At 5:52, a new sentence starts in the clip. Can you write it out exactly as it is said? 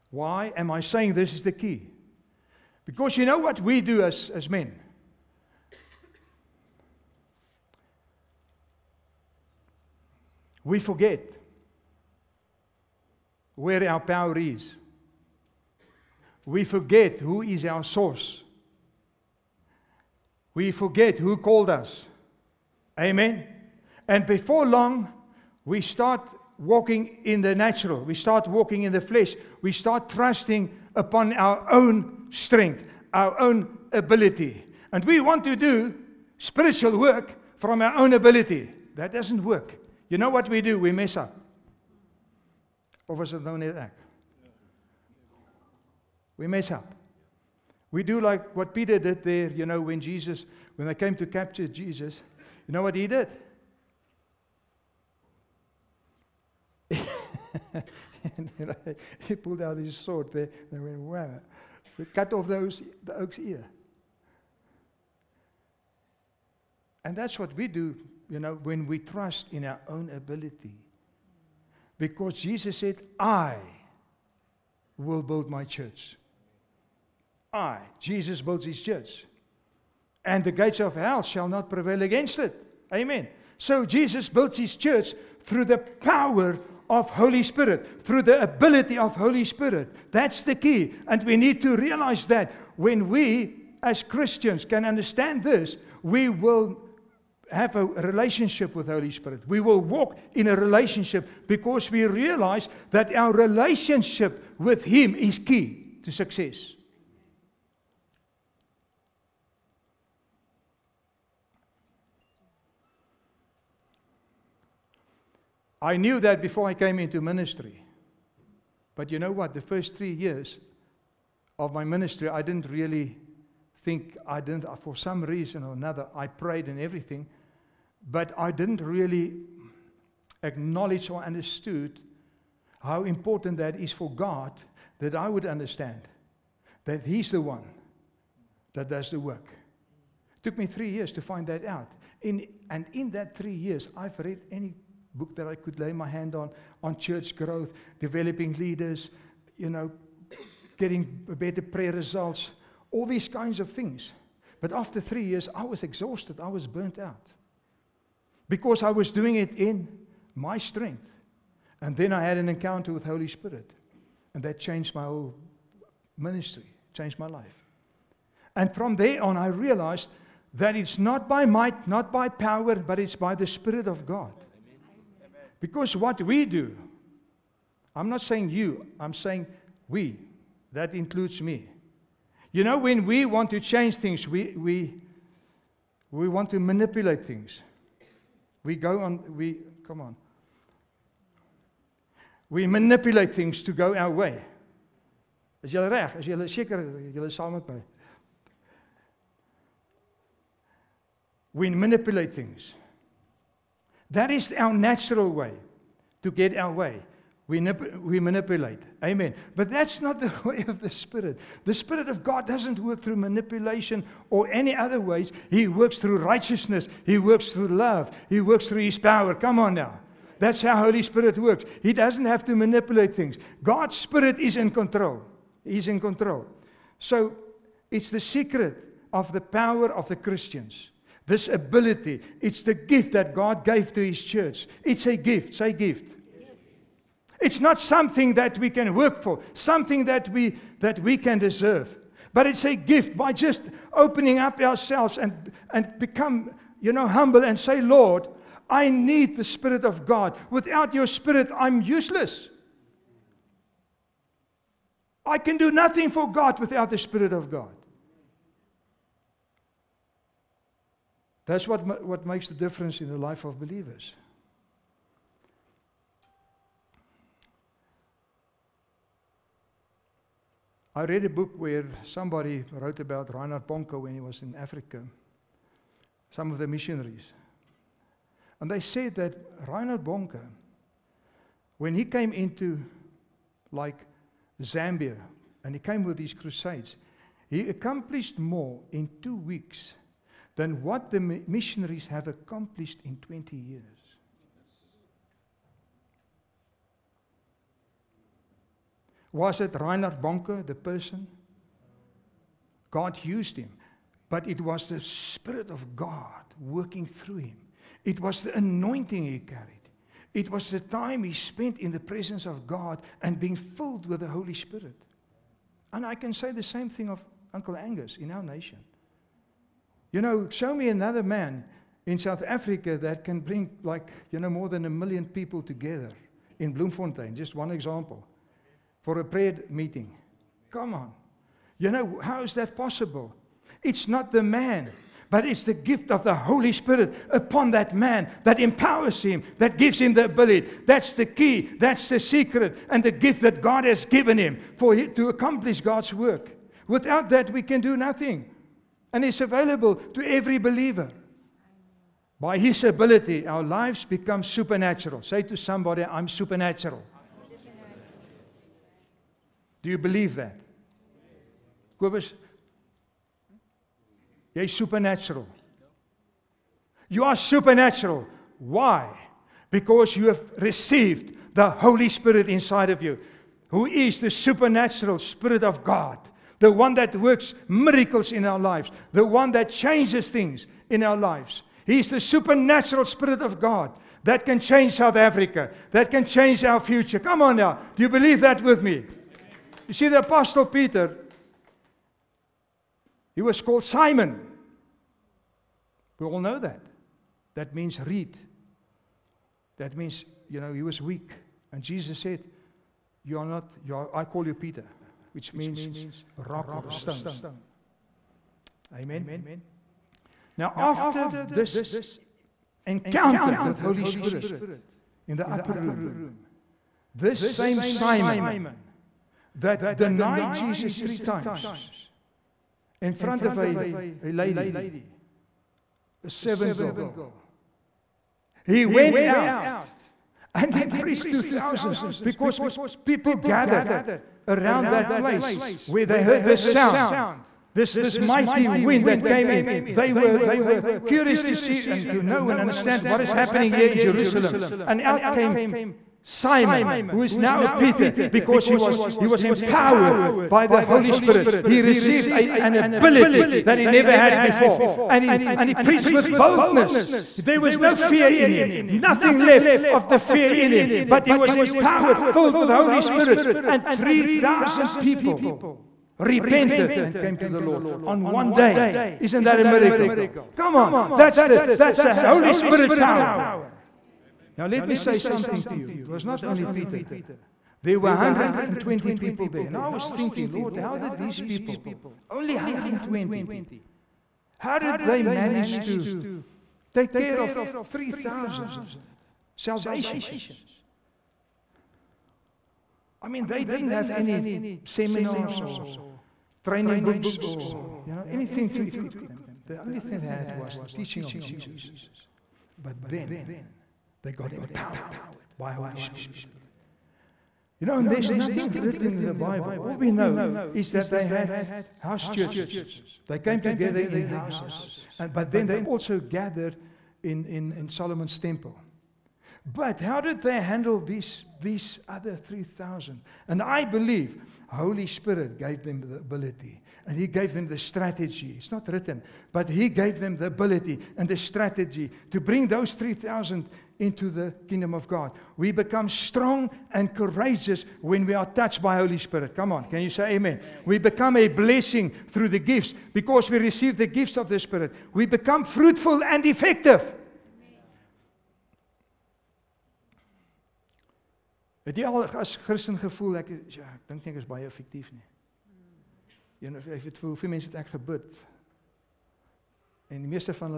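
By his ability, our lives become supernatural.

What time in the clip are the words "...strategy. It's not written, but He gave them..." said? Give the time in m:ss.
8:47.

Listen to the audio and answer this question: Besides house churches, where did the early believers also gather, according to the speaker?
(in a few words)
Solomon's temple.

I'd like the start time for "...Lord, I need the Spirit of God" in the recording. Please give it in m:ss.
4:07.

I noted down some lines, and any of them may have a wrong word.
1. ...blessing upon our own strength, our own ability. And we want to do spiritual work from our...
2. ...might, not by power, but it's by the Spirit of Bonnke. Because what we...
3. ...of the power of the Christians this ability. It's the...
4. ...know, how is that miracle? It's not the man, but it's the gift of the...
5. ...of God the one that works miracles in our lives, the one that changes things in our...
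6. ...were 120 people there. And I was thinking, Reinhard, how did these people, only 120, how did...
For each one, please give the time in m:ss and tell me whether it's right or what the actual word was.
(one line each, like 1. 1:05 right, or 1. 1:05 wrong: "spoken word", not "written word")
1. 0:30 wrong: "trusting", not "blessing"
2. 2:51 wrong: "God", not "Bonnke"
3. 3:49 right
4. 5:31 wrong: "possible", not "miracle"
5. 6:15 right
6. 7:57 wrong: "Lord", not "Reinhard".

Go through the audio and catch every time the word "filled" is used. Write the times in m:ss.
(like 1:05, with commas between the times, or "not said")
5:13, 7:42.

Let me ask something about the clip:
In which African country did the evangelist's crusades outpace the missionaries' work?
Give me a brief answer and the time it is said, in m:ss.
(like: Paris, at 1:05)
Zambia, at 4:44.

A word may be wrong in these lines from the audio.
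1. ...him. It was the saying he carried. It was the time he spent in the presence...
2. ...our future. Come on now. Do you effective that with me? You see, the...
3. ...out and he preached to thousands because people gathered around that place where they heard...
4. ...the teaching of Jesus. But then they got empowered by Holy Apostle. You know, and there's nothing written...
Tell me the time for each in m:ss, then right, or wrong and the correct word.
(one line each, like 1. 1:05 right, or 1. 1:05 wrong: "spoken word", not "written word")
1. 5:07 wrong: "anointing", not "saying"
2. 6:26 wrong: "believe", not "effective"
3. 7:09 right
4. 8:20 wrong: "Spirit", not "Apostle".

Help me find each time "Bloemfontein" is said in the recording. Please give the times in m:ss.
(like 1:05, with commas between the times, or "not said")
5:26.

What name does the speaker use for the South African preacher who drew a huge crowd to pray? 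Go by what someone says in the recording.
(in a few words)
Uncle Angus.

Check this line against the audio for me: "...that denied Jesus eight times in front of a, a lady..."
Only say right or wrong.
wrong.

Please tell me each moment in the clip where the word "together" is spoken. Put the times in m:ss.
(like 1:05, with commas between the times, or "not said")
5:25, 8:33.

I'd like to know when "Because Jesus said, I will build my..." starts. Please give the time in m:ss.
1:11.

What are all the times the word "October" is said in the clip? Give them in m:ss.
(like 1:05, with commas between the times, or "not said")
not said.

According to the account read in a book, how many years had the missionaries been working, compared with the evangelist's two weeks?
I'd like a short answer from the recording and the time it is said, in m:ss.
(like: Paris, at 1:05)
20, at 4:53.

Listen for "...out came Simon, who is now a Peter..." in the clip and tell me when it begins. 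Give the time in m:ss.
7:25.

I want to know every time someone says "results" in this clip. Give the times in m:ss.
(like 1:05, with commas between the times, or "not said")
2:31.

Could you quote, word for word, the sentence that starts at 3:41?
He doesn't have to manipulate things.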